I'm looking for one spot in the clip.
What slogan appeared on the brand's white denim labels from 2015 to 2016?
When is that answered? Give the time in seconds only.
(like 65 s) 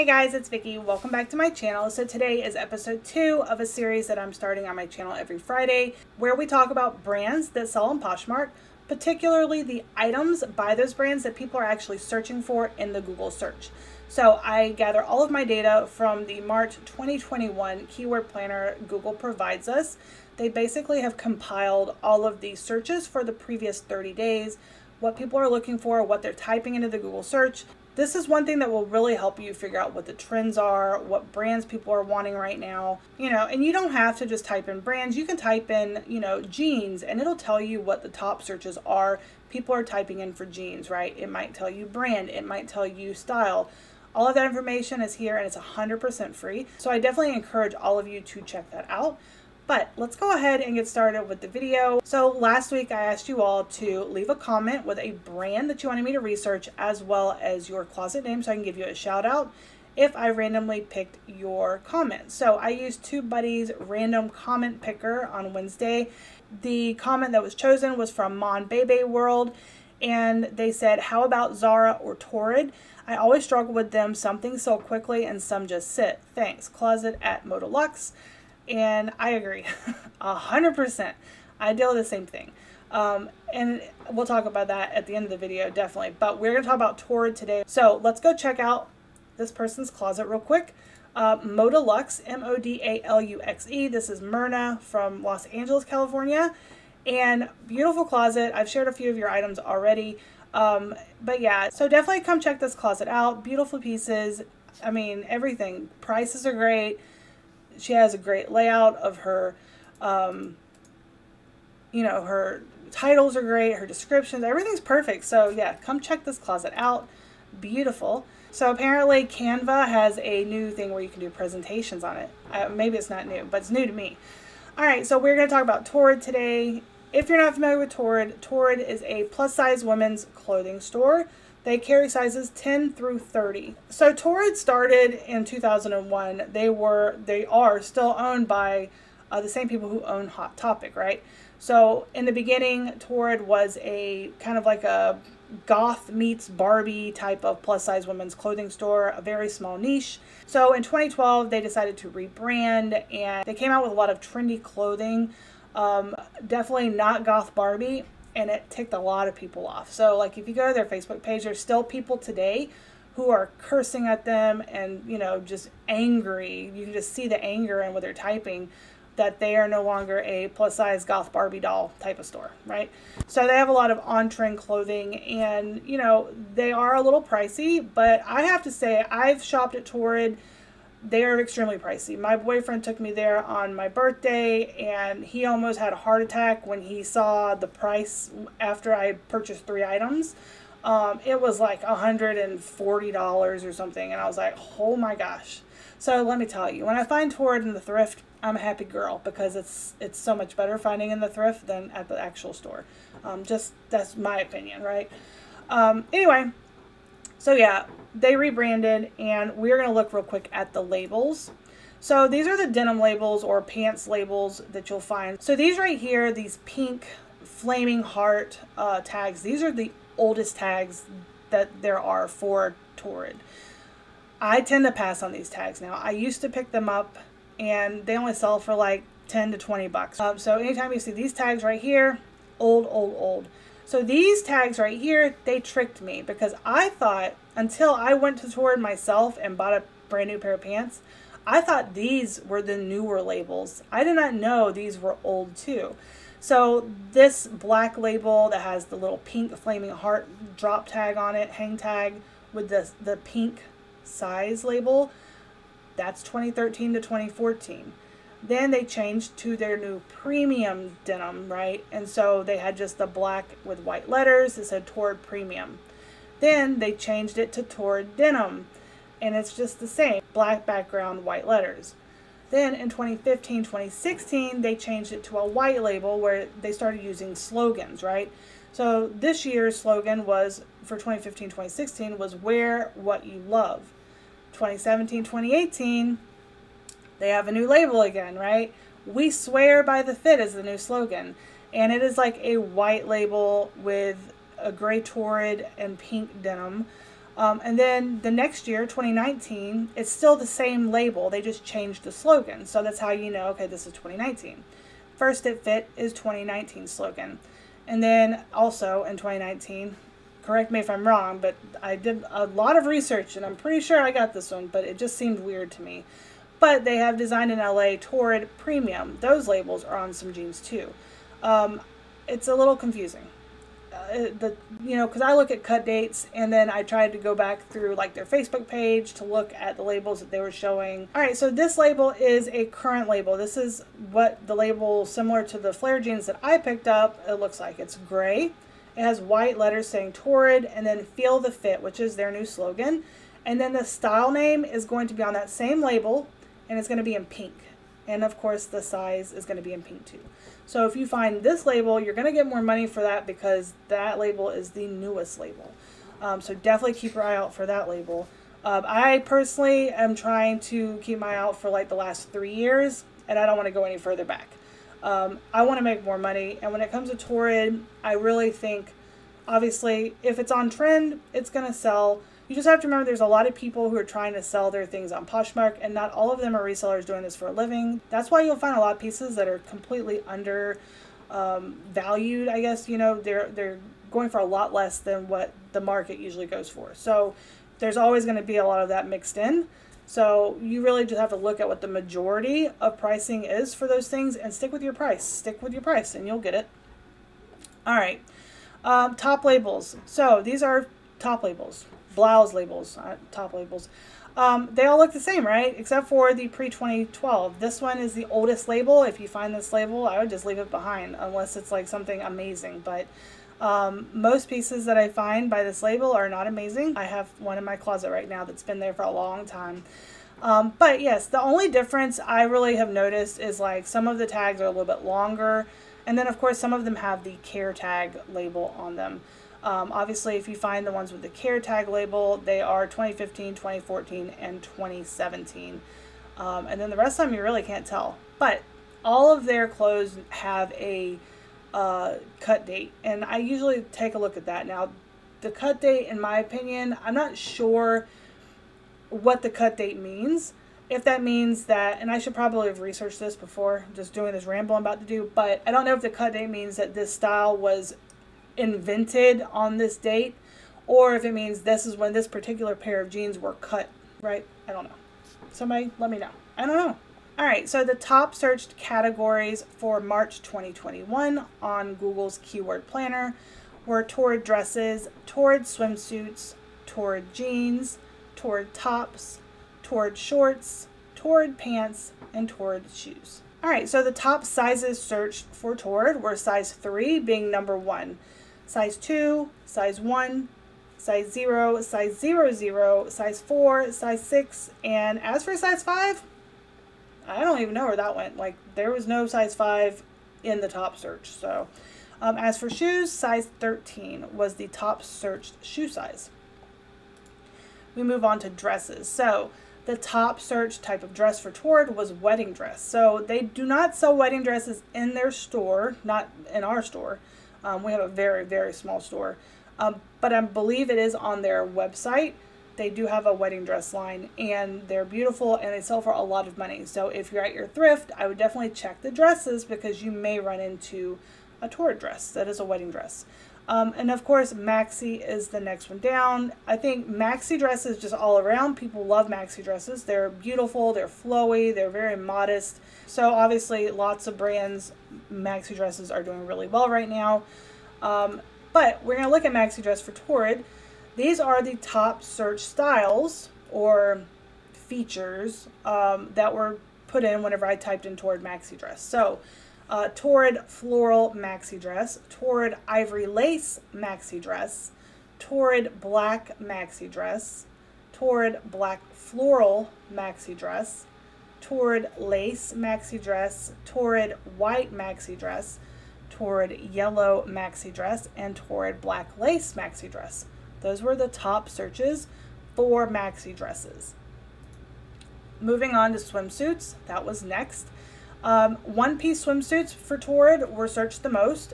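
282 s.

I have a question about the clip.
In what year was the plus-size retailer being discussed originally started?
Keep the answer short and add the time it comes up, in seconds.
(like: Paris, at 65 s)
2001, at 135 s.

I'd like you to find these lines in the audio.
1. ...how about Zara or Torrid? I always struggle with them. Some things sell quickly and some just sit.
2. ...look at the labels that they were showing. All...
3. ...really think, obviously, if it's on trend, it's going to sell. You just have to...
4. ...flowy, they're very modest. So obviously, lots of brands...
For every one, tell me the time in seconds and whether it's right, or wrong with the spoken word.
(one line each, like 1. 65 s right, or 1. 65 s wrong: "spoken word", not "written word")
1. 70 s right
2. 329 s right
3. 368 s right
4. 541 s right.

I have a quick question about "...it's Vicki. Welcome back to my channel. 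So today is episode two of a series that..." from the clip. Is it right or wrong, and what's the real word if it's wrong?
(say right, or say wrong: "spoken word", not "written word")
right.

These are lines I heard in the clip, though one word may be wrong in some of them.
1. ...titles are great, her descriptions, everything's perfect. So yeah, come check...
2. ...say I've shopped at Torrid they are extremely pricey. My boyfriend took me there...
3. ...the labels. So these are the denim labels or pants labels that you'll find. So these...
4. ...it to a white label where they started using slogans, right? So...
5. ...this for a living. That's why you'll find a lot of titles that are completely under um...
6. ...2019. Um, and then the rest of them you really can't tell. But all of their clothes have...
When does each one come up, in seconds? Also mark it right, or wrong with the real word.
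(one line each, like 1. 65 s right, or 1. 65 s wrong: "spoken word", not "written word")
1. 112 s right
2. 178 s right
3. 210 s right
4. 275 s right
5. 377 s wrong: "pieces", not "titles"
6. 434 s wrong: "2017", not "2019".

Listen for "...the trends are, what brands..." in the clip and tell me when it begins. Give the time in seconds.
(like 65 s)
30 s.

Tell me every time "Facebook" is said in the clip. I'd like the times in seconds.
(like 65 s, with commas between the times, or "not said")
160 s, 328 s.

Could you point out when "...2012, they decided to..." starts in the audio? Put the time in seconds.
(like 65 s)
150 s.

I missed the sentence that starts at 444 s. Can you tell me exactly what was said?
Now, the cut date, in my opinion, I'm not sure what the cut date means.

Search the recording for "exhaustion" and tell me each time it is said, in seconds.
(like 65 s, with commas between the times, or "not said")
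not said.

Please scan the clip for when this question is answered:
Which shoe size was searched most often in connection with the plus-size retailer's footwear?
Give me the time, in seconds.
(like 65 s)
503 s.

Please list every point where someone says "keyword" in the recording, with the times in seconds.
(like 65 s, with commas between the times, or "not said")
17 s, 472 s.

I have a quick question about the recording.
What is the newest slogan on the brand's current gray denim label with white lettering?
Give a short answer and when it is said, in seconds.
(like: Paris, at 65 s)
Feel the Fit, at 341 s.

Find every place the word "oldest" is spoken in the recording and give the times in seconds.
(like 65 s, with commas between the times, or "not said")
220 s, 408 s.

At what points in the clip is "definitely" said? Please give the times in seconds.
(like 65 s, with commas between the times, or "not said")
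47 s, 85 s, 101 s, 156 s, 356 s, 528 s.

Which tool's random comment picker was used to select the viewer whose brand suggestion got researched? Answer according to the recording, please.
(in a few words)
TubeBuddy.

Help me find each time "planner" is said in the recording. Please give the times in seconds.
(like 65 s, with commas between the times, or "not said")
18 s, 472 s.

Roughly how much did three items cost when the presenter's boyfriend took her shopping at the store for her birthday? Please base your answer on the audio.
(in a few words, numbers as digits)
$140.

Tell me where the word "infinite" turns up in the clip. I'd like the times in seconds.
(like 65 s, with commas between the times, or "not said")
not said.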